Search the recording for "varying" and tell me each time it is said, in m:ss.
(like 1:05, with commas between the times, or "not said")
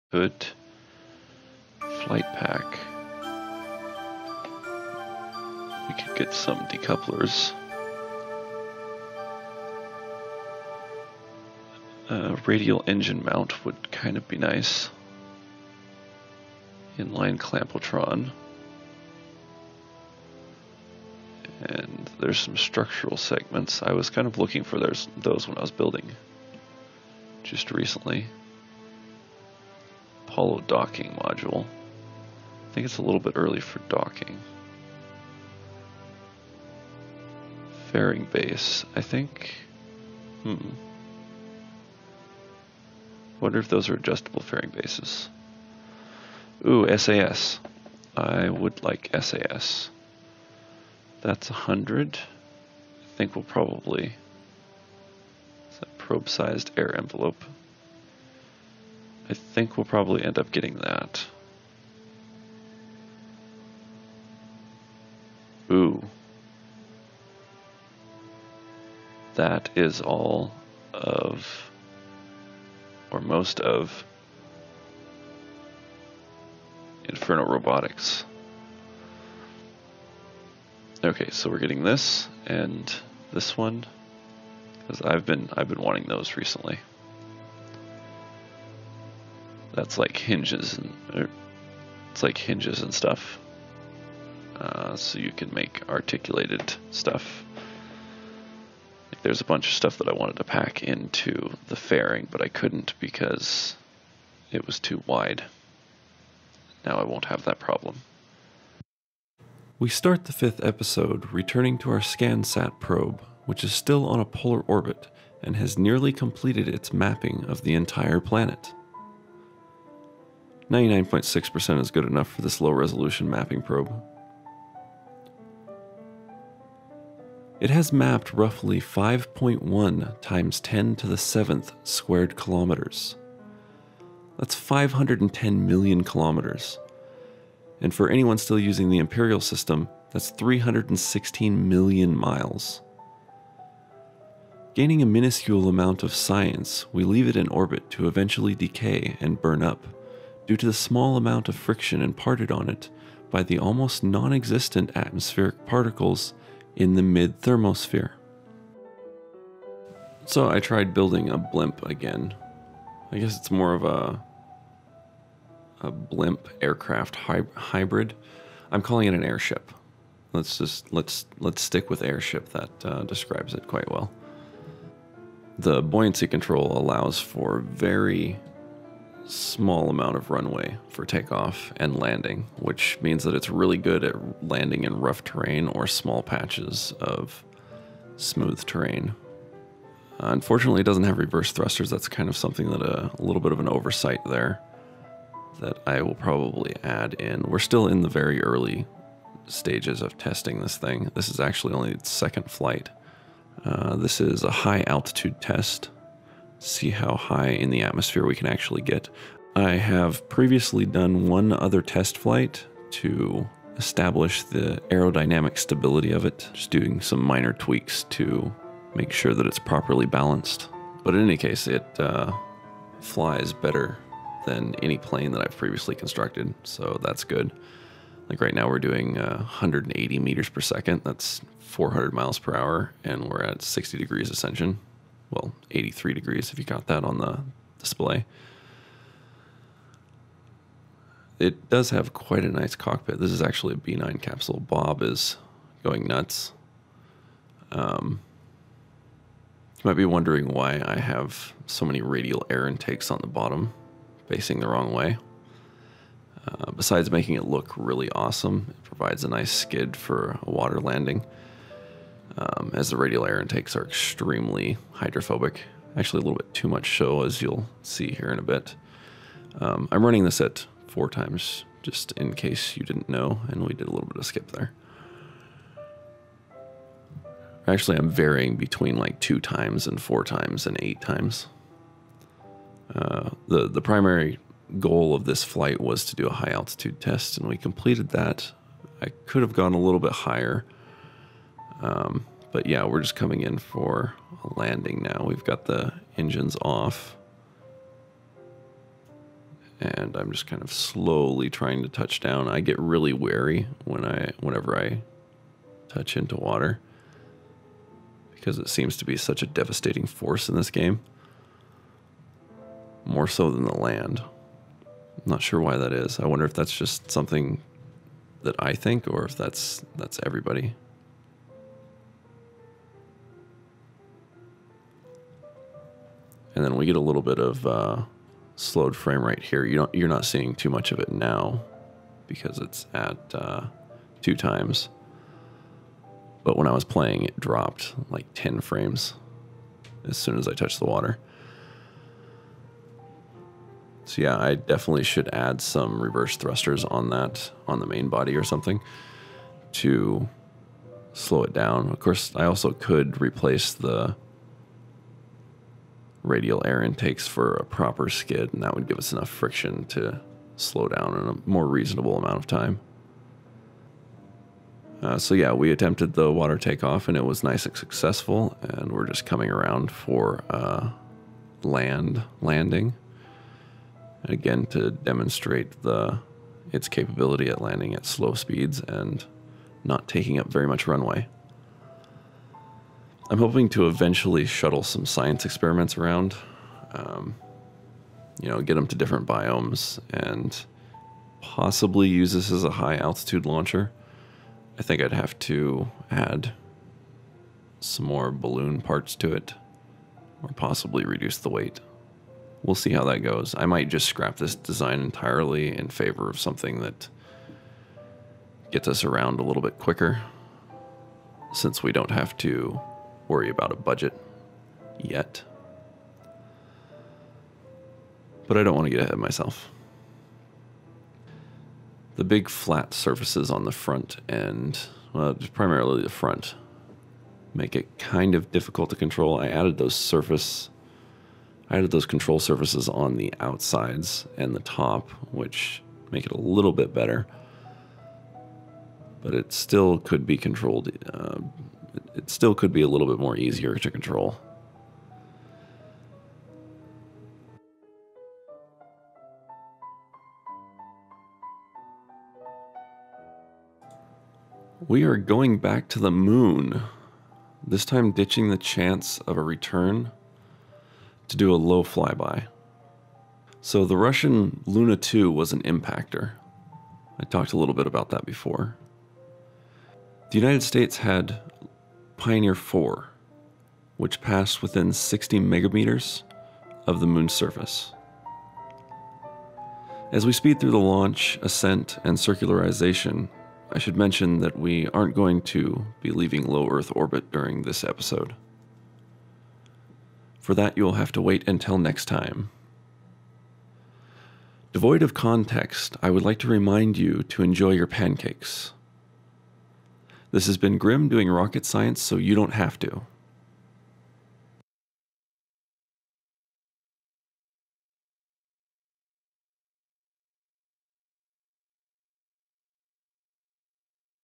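4:38.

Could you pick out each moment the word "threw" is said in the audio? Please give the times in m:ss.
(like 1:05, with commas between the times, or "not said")
not said.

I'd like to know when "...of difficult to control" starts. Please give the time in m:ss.
7:08.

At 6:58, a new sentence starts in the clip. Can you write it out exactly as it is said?
But I don't want to get ahead of myself.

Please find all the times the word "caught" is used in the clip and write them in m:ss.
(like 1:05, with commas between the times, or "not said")
not said.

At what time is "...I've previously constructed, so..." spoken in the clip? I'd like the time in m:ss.
3:45.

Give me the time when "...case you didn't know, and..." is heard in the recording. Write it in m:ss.
4:32.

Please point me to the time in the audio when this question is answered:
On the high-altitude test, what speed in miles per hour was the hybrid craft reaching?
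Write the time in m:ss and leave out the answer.
3:51.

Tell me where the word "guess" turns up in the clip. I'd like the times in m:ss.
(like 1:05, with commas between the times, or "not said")
2:43.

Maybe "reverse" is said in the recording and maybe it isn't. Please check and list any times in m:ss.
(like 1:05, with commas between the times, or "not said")
3:11, 5:45.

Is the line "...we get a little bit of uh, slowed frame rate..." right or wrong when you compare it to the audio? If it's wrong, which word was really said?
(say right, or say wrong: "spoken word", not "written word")
right.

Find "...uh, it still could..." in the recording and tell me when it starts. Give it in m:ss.
7:21.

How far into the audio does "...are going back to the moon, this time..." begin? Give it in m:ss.
7:35.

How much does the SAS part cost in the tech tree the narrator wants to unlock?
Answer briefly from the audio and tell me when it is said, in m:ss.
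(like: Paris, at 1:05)
100, at 0:51.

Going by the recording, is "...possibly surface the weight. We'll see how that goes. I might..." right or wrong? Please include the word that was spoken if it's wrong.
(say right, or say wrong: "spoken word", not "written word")
wrong: "reduce", not "surface".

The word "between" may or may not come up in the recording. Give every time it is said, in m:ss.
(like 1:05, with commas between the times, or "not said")
4:38.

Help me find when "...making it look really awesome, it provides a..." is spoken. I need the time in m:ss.
4:17.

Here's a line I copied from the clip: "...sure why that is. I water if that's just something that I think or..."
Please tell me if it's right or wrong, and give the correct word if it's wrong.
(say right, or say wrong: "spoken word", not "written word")
wrong: "wonder", not "water".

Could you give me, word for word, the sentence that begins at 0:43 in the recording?
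Wonder if those are adjustable fairing bases.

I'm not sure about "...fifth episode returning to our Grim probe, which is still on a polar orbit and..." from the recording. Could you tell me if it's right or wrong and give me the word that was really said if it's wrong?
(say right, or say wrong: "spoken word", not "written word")
wrong: "ScanSat", not "Grim".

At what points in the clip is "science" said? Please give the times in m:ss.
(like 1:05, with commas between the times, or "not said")
2:26, 6:25, 8:21.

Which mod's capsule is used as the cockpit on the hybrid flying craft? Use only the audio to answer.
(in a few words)
B9.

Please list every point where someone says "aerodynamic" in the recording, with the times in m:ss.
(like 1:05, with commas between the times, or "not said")
3:34.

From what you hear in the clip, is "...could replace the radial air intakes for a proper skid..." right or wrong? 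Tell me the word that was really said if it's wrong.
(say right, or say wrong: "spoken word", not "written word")
right.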